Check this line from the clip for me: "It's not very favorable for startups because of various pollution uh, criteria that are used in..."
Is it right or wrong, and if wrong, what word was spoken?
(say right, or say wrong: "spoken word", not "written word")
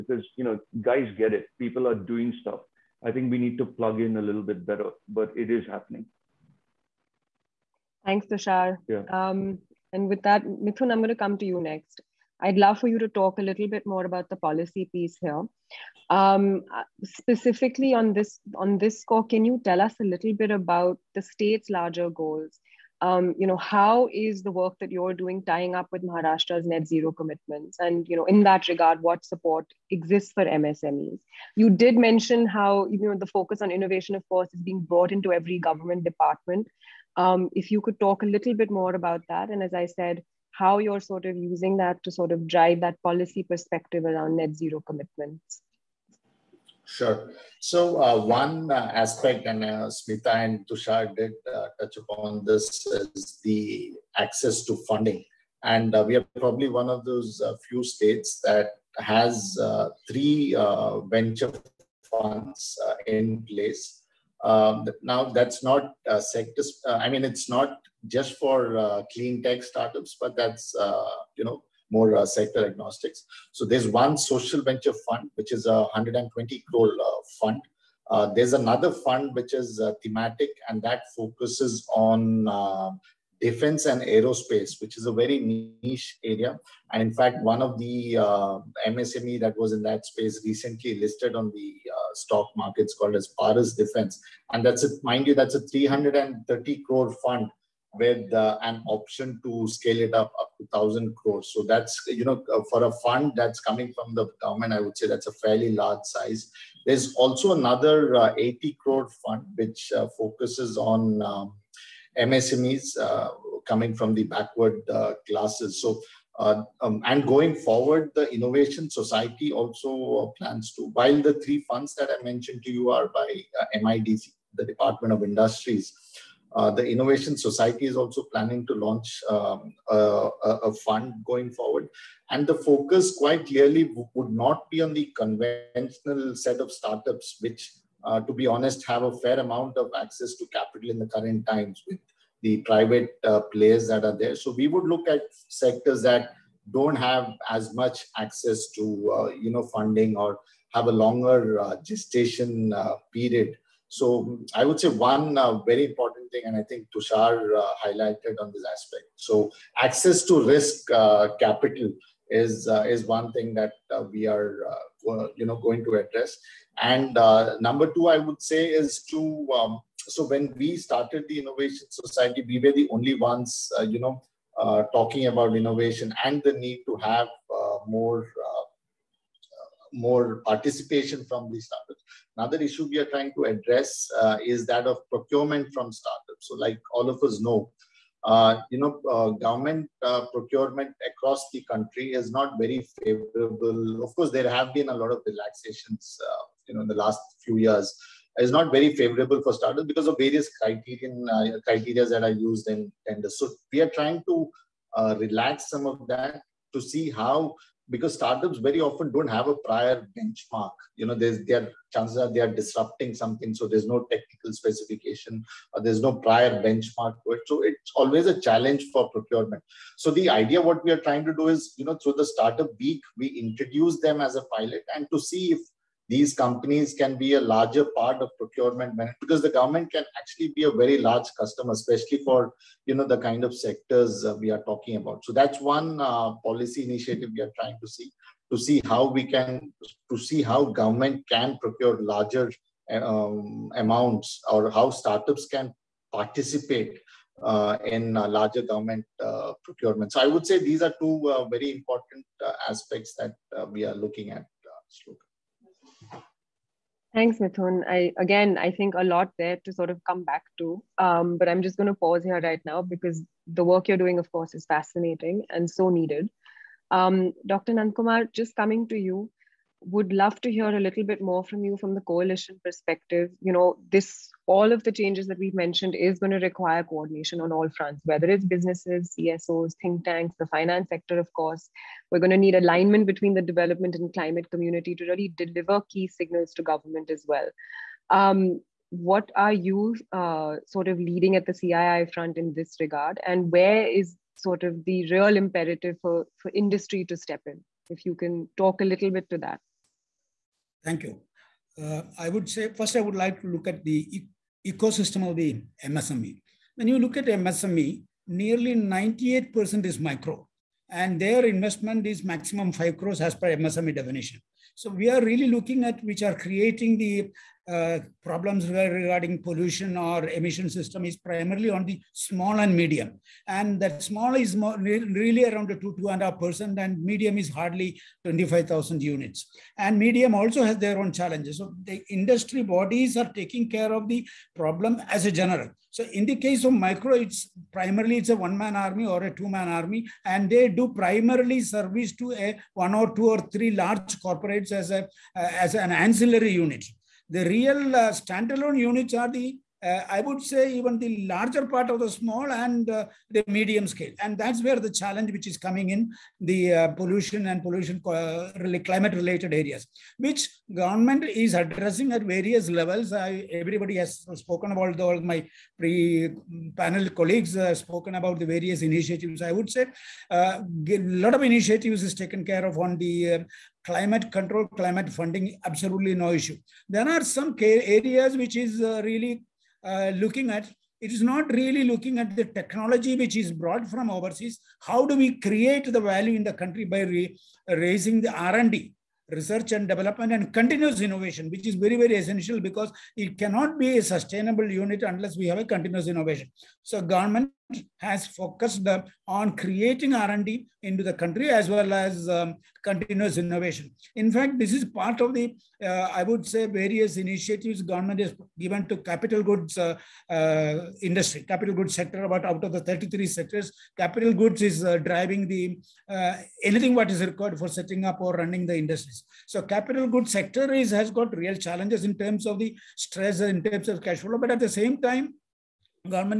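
wrong: "criterion", not "pollution".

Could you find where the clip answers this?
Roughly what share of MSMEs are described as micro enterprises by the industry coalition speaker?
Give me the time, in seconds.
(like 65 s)
308 s.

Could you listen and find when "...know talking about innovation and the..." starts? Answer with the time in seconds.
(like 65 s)
173 s.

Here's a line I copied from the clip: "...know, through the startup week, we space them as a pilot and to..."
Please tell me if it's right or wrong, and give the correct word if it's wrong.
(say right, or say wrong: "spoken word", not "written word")
wrong: "introduce", not "space".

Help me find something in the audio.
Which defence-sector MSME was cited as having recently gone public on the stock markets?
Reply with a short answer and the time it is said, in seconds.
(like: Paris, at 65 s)
Paras Defence, at 93 s.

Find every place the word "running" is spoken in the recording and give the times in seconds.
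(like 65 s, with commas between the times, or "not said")
418 s.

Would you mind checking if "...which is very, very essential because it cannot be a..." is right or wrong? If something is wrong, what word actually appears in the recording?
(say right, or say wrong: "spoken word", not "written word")
right.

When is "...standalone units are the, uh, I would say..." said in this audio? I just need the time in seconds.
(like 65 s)
348 s.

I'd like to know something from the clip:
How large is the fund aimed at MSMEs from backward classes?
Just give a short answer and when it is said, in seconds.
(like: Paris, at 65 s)
80 crore, at 108 s.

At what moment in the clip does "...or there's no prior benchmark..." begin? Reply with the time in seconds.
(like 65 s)
215 s.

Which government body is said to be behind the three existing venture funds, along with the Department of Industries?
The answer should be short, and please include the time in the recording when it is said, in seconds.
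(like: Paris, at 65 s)
MIDC, at 123 s.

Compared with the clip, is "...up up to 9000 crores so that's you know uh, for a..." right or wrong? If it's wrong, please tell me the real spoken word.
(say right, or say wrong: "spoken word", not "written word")
wrong: "1000", not "9000".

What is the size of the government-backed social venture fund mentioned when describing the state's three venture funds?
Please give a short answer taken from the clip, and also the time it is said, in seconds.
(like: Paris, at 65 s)
120 crore, at 75 s.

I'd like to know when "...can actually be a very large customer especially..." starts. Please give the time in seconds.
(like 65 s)
229 s.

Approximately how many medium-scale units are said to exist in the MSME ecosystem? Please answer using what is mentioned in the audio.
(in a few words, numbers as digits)
25,000.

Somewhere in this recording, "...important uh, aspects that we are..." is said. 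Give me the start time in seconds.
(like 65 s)
251 s.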